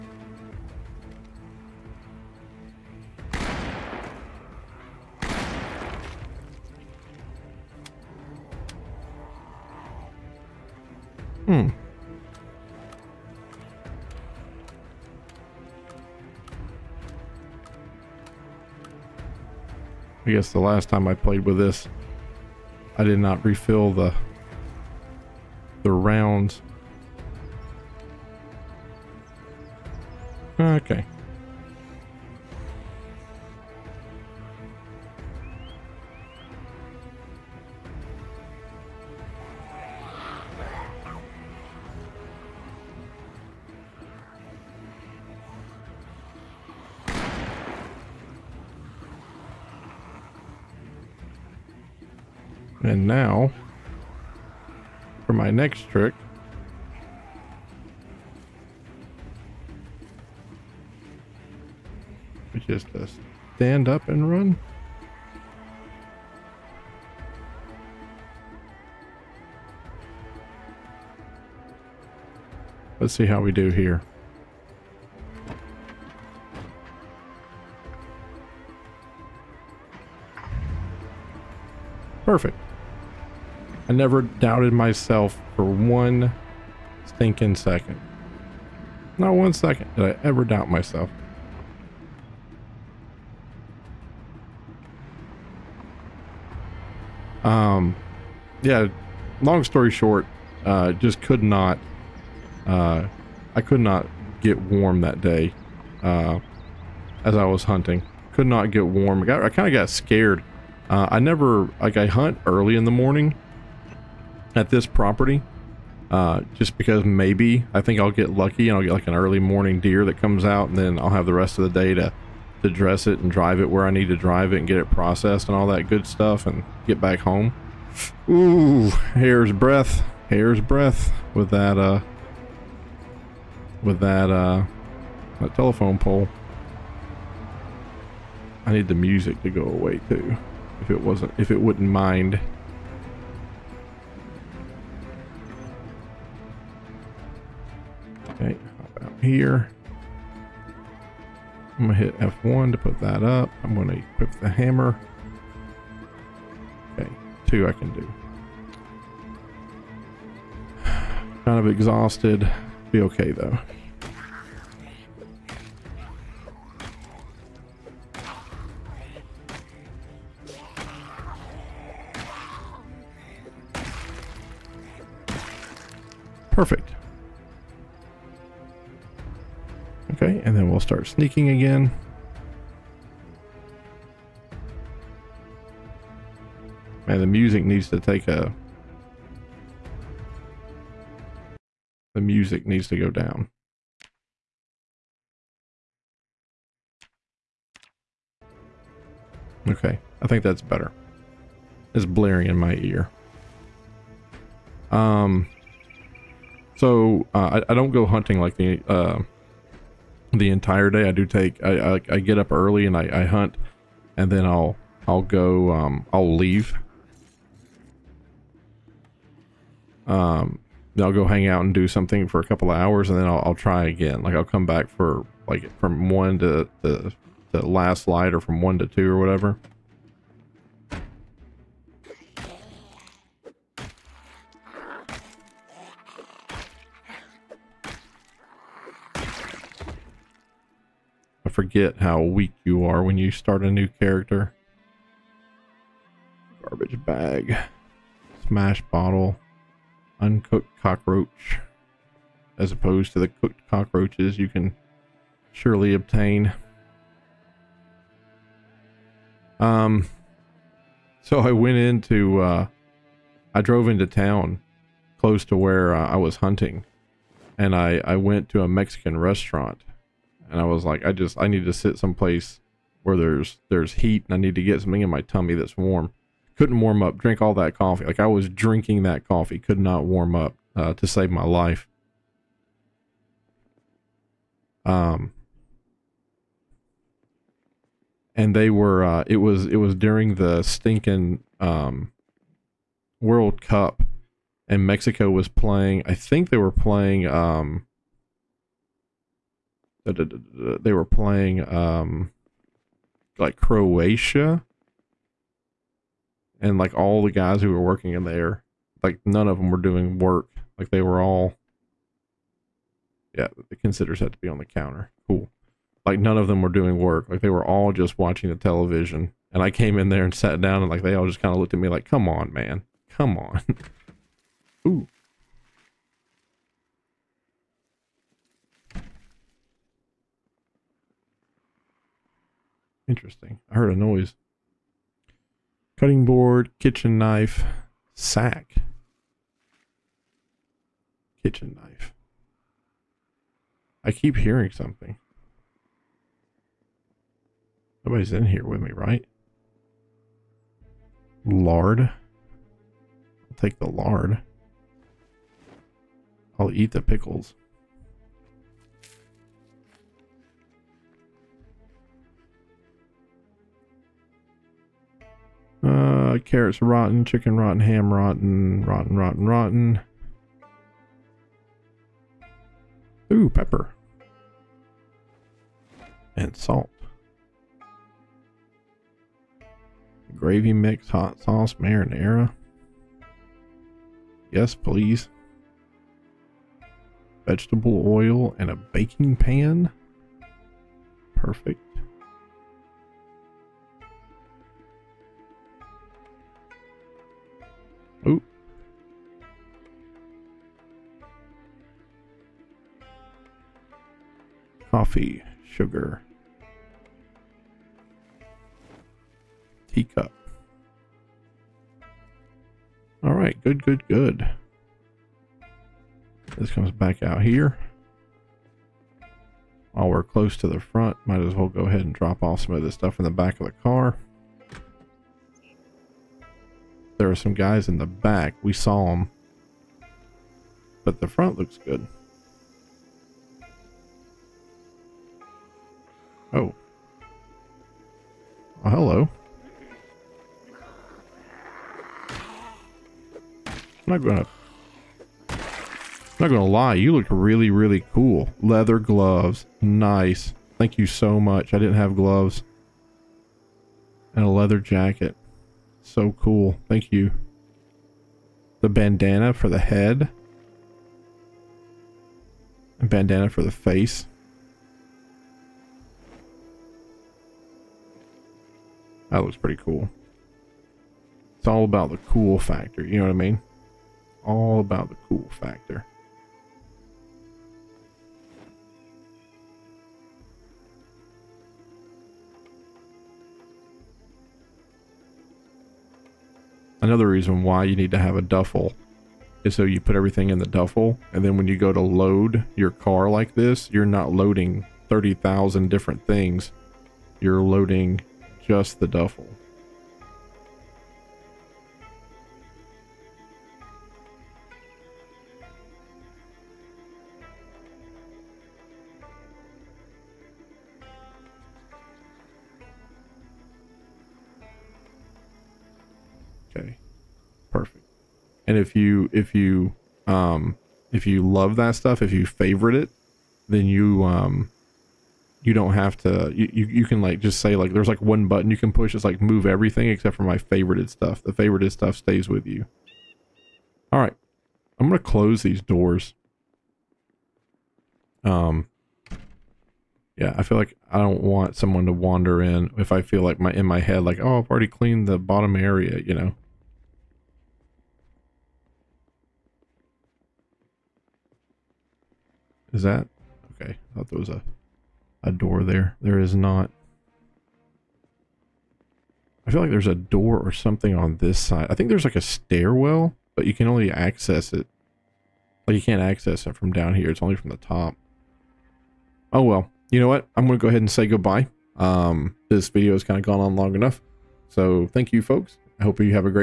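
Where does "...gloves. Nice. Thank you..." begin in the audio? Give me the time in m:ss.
7:28.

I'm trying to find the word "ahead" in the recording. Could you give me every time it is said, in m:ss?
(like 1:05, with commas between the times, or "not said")
7:01, 9:30.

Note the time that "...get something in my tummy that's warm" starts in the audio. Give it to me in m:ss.
4:34.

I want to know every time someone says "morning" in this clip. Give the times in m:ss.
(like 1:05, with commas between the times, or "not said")
1:52, 1:59.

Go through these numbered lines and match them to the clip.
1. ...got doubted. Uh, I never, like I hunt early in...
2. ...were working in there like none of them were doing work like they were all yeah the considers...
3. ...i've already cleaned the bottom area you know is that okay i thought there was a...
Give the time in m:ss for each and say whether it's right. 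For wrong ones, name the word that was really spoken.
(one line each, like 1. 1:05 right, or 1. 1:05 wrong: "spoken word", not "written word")
1. 1:49 wrong: "scared", not "doubted"
2. 5:07 right
3. 9:04 right.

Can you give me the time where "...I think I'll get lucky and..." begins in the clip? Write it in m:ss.
1:57.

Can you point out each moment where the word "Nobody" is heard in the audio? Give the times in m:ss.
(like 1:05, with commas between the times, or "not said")
5:48.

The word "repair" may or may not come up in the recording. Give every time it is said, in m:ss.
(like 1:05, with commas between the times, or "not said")
not said.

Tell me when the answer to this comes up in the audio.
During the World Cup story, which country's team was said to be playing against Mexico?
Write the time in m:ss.
5:03.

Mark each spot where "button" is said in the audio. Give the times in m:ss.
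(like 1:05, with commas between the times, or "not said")
8:48.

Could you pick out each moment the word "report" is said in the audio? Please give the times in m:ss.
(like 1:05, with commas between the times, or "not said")
not said.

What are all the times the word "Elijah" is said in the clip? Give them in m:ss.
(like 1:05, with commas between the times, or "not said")
not said.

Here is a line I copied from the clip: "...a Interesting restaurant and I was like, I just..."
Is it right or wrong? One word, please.
wrong.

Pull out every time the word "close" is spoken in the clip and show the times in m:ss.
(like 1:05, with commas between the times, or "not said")
4:25, 7:00, 8:55.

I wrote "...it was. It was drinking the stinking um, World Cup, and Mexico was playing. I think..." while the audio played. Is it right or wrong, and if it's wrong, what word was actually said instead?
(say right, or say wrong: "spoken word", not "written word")
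wrong: "during", not "drinking".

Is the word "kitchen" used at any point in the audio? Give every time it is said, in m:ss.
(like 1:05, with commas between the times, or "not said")
5:36, 5:41.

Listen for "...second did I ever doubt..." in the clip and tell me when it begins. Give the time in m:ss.
1:29.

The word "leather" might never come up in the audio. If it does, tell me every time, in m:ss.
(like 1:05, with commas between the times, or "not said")
7:28, 7:34.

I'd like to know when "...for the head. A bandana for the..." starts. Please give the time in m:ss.
7:39.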